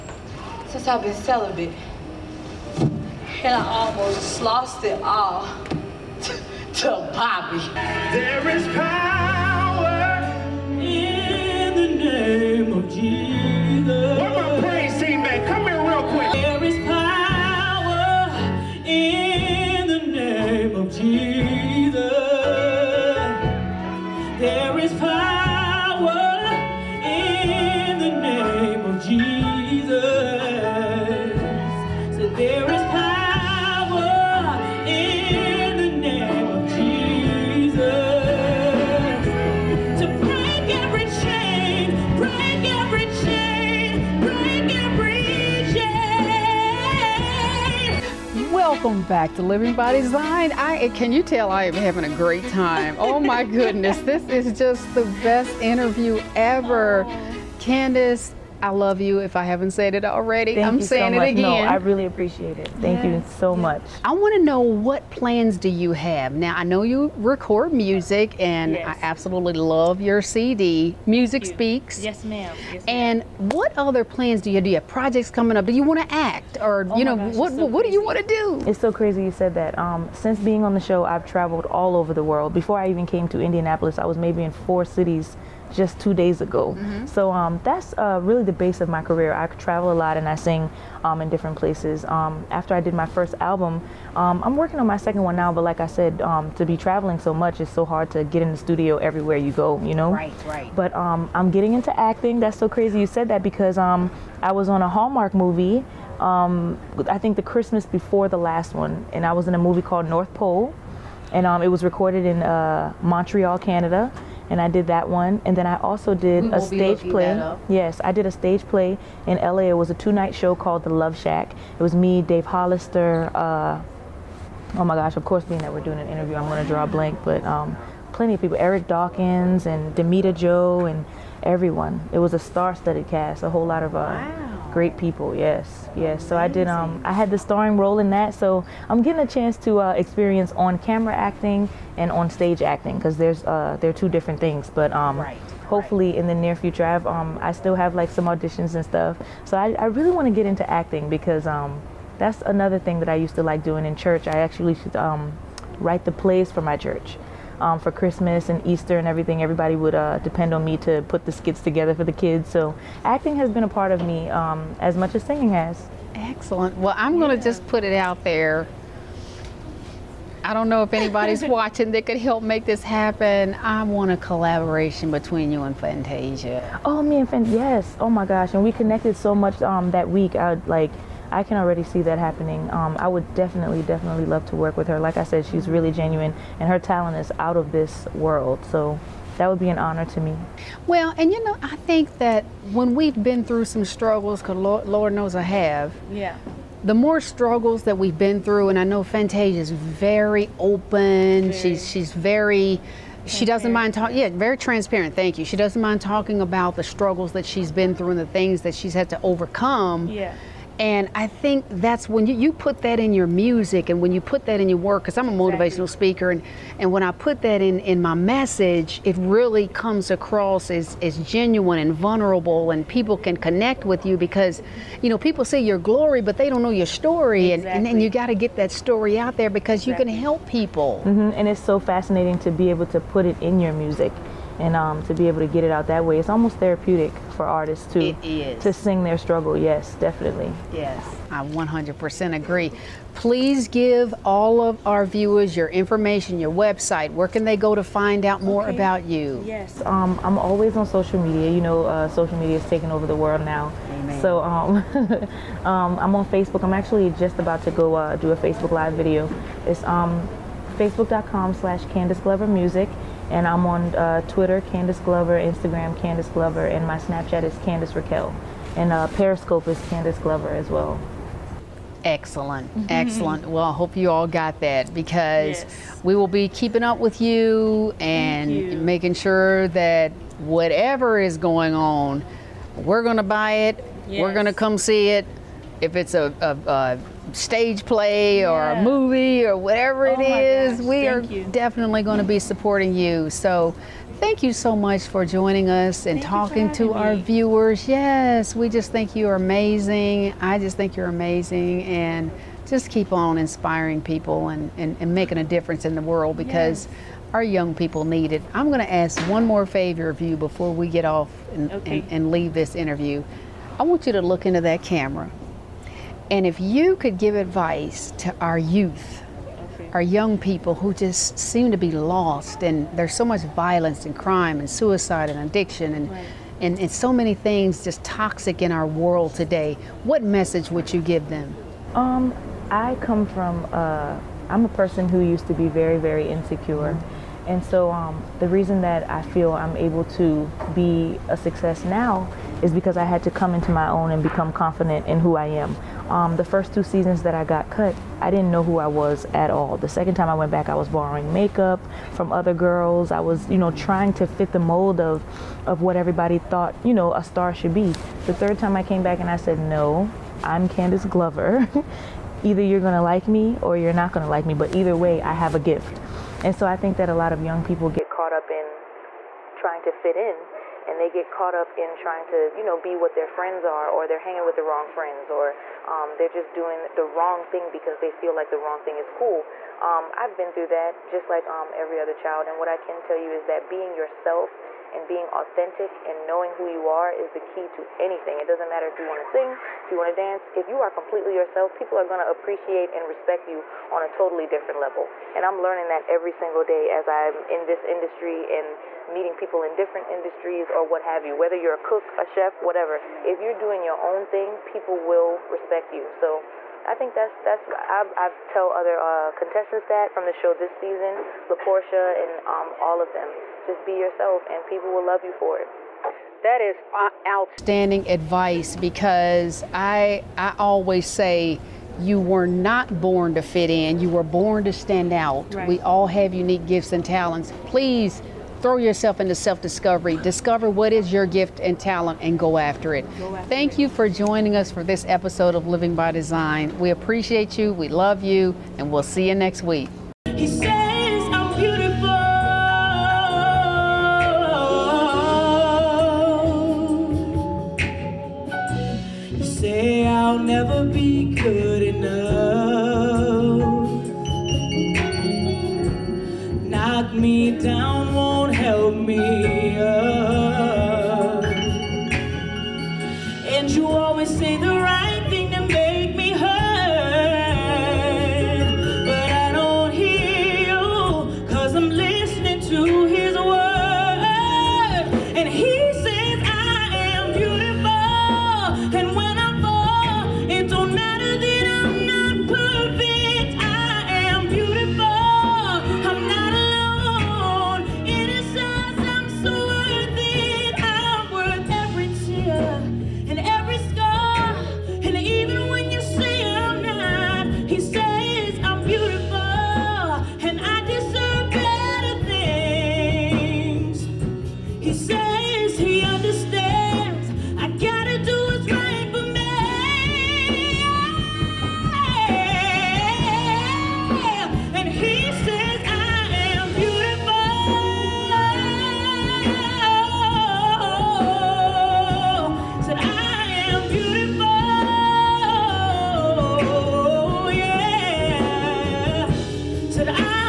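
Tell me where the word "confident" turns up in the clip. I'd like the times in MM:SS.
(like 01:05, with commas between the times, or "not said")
05:44.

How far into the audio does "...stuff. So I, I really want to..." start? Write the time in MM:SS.
02:28.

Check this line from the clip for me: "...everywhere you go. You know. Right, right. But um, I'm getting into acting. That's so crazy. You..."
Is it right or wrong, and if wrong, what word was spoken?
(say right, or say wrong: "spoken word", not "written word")
right.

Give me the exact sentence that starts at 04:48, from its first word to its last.
a movie or whatever it oh is, oh gosh, we are you.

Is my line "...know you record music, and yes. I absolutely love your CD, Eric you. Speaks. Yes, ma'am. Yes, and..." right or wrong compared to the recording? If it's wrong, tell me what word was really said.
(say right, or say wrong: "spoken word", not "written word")
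wrong: "Music", not "Eric".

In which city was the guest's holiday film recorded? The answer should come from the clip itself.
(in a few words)
Montreal.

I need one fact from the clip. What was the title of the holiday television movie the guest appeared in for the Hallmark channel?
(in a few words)
North Pole.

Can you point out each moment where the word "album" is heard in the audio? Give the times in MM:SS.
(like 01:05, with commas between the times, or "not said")
01:33.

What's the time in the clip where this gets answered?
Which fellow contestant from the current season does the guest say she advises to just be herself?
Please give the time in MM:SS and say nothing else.
06:51.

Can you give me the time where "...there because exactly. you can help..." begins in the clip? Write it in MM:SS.
03:49.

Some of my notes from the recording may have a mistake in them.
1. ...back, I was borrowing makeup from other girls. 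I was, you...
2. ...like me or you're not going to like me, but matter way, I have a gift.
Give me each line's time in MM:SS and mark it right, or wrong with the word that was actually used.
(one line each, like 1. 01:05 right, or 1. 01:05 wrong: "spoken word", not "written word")
1. 05:50 right
2. 06:03 wrong: "either", not "matter".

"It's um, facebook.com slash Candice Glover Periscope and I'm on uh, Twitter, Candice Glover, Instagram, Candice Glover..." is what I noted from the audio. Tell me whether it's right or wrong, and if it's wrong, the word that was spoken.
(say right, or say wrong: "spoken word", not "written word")
wrong: "Music", not "Periscope".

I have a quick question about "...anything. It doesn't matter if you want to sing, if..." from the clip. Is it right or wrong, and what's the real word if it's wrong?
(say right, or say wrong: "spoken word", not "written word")
right.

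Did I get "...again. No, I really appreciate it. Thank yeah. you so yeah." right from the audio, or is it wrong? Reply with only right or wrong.
right.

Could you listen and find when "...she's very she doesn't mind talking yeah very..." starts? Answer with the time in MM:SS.
03:21.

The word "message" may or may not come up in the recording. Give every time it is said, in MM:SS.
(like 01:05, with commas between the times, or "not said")
03:38, 05:30.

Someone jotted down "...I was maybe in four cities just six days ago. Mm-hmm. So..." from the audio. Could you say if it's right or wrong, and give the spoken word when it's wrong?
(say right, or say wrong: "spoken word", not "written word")
wrong: "two", not "six".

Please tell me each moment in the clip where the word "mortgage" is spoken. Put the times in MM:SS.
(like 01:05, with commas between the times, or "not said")
not said.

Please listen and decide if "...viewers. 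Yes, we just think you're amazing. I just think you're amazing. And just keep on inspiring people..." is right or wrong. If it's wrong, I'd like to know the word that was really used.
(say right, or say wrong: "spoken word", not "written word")
right.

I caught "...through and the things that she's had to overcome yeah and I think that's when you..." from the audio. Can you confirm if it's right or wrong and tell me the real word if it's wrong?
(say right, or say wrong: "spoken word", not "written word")
right.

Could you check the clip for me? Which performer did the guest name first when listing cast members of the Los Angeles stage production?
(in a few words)
Dave Hollister.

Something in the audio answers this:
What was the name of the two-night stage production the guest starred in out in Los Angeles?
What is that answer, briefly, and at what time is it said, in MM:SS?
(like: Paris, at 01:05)
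The Love Shack, at 02:00.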